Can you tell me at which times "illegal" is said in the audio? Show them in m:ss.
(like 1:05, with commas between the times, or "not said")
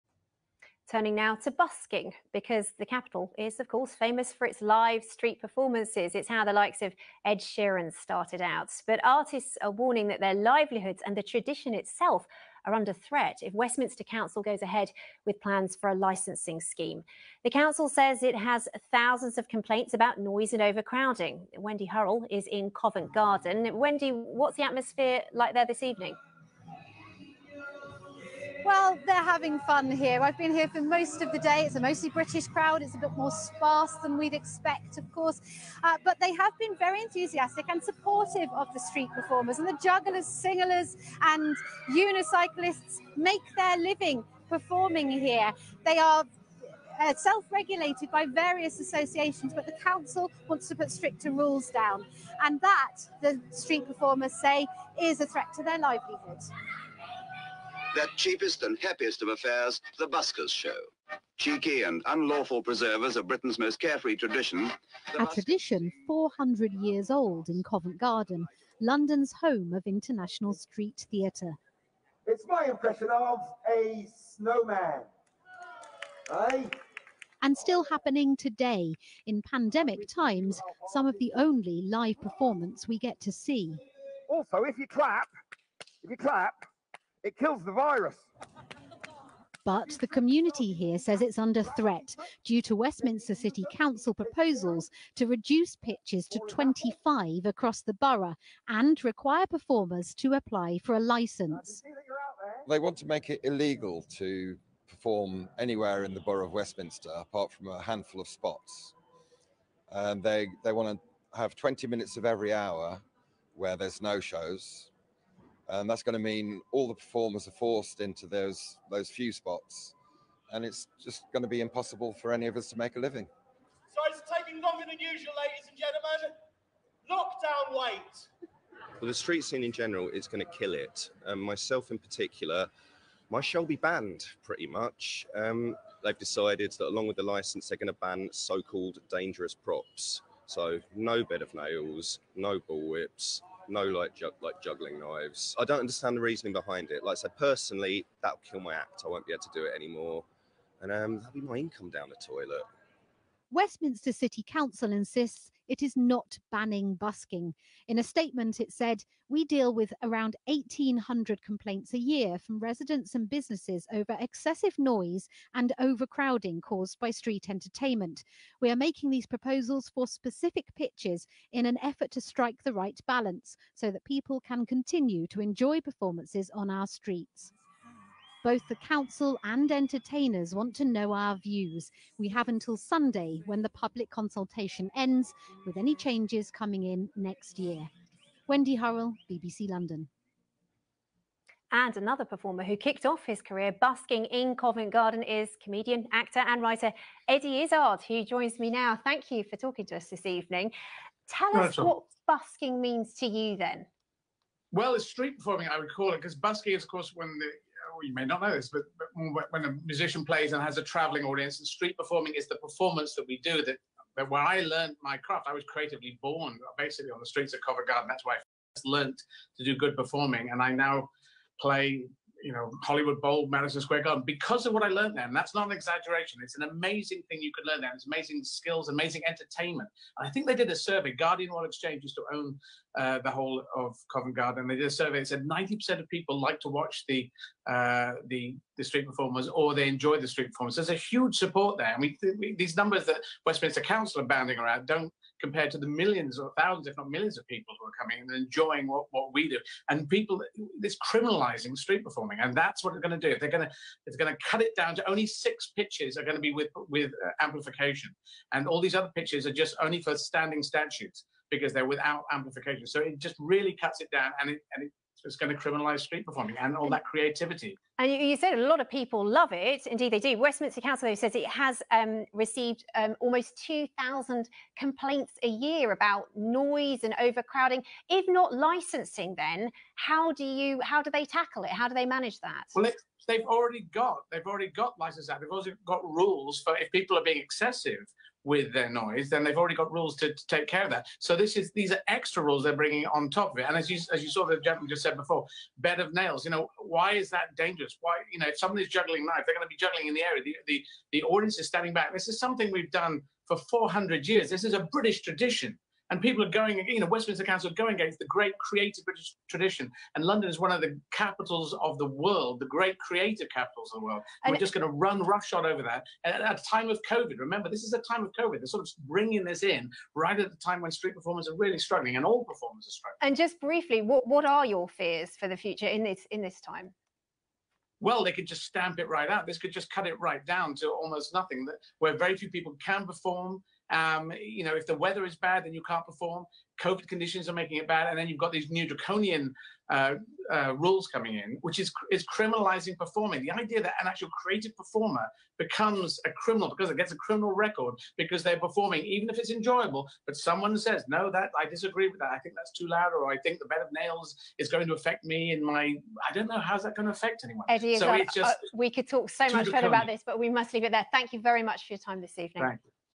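1:43.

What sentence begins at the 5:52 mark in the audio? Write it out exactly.
I think that's too loud, or I think the bed of nails is going to affect me in my.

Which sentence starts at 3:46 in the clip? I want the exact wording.
It's an amazing thing you could learn there.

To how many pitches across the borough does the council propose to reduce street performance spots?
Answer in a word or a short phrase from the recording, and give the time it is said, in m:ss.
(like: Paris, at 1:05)
25, at 1:36.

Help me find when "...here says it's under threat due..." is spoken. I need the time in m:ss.
1:30.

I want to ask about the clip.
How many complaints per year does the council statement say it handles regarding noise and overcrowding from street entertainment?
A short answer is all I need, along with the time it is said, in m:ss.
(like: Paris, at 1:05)
1,800, at 2:40.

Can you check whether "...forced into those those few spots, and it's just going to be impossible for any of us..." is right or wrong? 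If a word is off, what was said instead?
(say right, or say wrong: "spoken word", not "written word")
right.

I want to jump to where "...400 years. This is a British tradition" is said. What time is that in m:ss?
5:03.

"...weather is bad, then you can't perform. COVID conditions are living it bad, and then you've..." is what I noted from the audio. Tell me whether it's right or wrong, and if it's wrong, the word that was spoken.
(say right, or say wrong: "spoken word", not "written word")
wrong: "making", not "living".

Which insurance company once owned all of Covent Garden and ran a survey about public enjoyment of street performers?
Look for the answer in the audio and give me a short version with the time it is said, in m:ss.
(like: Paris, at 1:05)
Guardian Royal Exchange, at 3:51.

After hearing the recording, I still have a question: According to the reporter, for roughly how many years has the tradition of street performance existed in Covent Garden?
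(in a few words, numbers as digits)
400 years.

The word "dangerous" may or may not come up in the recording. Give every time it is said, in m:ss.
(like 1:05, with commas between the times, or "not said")
2:19, 4:57.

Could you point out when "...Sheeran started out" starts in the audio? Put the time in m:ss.
0:07.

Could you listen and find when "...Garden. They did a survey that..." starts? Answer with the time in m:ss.
3:54.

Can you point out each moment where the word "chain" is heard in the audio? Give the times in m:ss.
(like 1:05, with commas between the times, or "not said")
not said.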